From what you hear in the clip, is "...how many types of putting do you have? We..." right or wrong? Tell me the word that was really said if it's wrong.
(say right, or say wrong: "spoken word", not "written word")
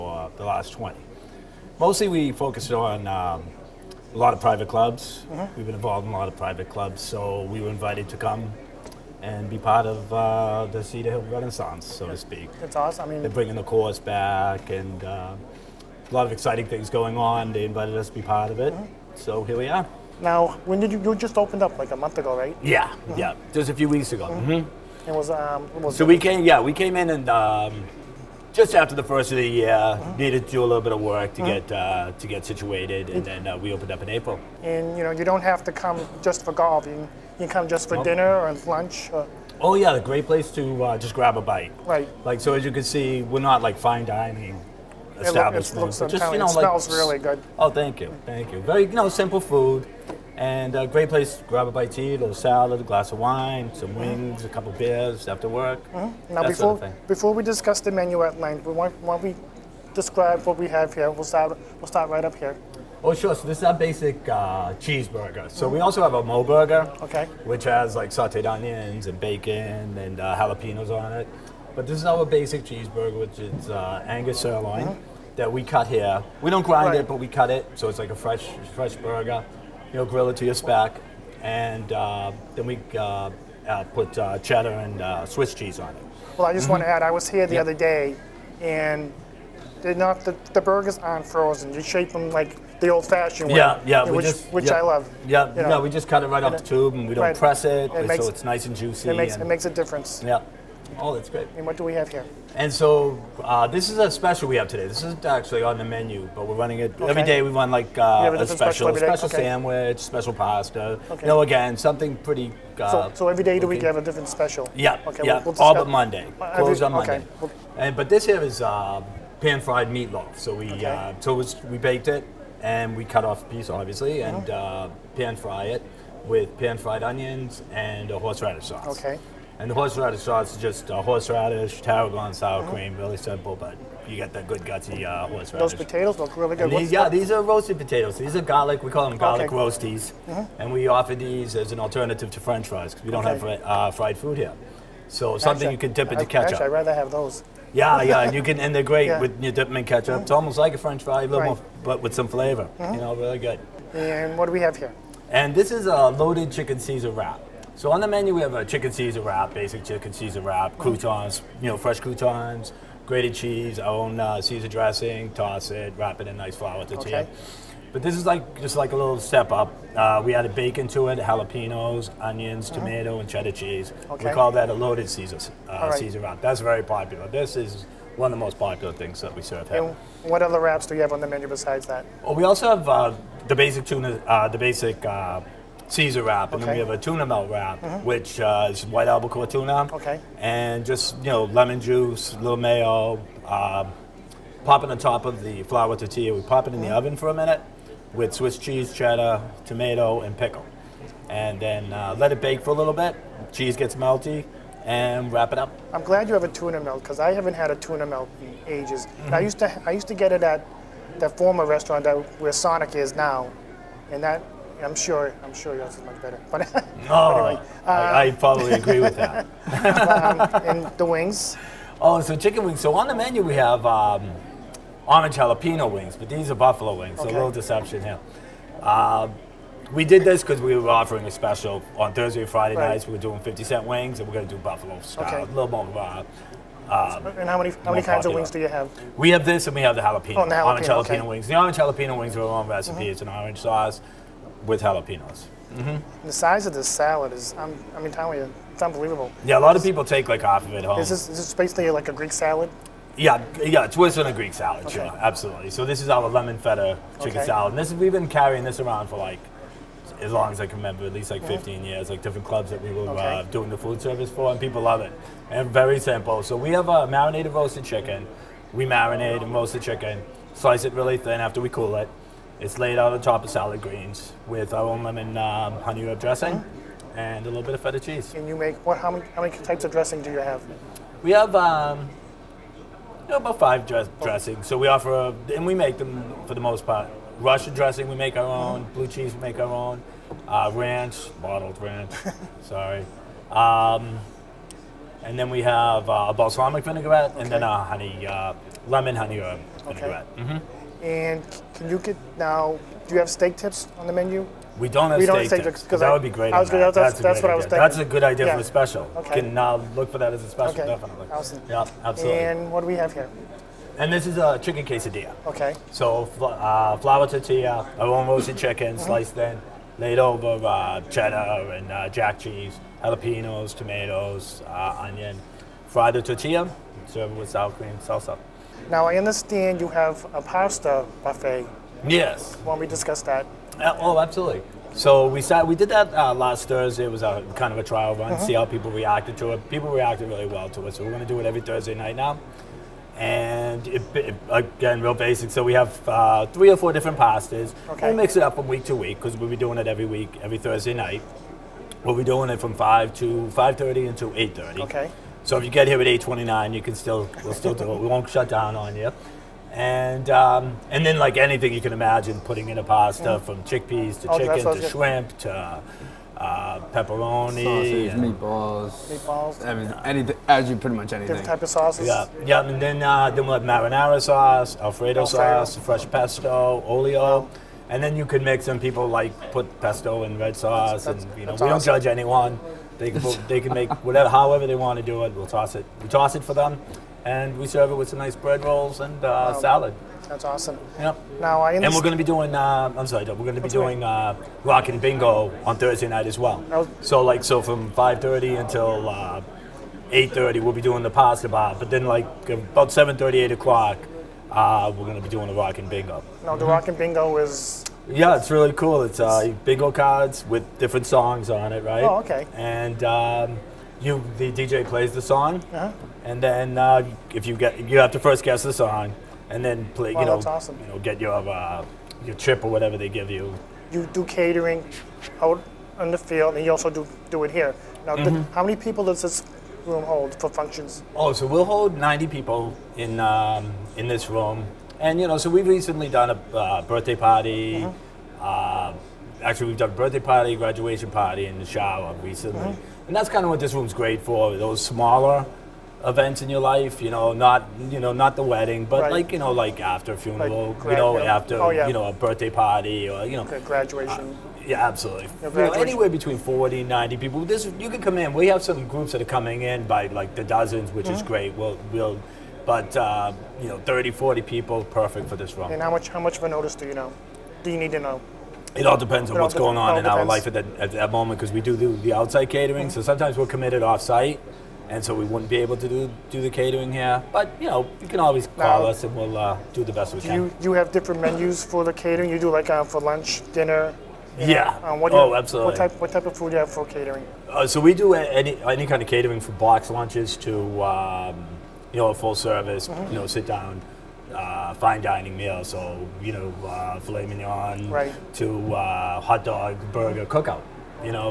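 wrong: "dressing", not "putting".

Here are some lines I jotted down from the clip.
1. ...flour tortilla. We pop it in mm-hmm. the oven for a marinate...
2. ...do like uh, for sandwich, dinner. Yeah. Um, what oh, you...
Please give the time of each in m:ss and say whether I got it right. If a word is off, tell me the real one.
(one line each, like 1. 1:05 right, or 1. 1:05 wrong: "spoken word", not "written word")
1. 3:15 wrong: "minute", not "marinate"
2. 8:02 wrong: "lunch", not "sandwich".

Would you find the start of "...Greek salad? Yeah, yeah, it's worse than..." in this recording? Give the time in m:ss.
4:12.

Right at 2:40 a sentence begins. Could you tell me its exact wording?
croutons, you know, fresh croutons, grated cheese, our own uh, Caesar dressing, toss it, wrap it in nice flour tortilla.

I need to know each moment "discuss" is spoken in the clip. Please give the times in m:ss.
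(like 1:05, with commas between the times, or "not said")
0:57, 5:32.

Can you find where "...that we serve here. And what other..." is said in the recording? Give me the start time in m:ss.
2:59.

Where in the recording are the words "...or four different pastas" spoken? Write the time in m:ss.
5:46.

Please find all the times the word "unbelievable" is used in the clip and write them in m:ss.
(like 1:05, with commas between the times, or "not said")
4:08.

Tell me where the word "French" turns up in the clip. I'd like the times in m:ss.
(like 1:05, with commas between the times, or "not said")
2:22, 2:30.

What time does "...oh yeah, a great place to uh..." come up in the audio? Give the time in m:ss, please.
0:39.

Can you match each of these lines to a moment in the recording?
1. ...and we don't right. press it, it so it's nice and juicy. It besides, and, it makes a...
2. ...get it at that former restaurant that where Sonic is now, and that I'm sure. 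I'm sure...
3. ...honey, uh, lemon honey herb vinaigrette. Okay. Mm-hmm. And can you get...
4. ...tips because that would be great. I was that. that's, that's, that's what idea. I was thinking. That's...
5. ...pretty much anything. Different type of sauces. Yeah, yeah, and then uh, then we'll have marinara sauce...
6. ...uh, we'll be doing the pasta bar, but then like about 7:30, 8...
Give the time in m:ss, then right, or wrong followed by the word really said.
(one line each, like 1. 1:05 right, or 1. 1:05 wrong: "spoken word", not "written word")
1. 1:36 wrong: "makes", not "besides"
2. 3:30 right
3. 4:57 right
4. 5:05 right
5. 6:10 right
6. 6:40 right.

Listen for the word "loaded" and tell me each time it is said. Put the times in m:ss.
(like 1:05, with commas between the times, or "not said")
2:36, 2:54.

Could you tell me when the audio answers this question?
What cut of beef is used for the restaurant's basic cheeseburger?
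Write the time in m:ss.
1:14.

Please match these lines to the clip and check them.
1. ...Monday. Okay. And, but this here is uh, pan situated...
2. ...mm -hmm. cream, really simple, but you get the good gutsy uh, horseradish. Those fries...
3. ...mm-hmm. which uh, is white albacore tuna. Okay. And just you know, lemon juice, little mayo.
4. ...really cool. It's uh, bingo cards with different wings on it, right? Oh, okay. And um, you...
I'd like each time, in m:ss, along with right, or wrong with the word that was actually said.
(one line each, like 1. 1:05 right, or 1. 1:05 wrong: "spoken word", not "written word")
1. 1:56 wrong: "fried", not "situated"
2. 2:12 wrong: "potatoes", not "fries"
3. 3:07 right
4. 6:48 wrong: "songs", not "wings".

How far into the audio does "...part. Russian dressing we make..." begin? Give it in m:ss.
4:46.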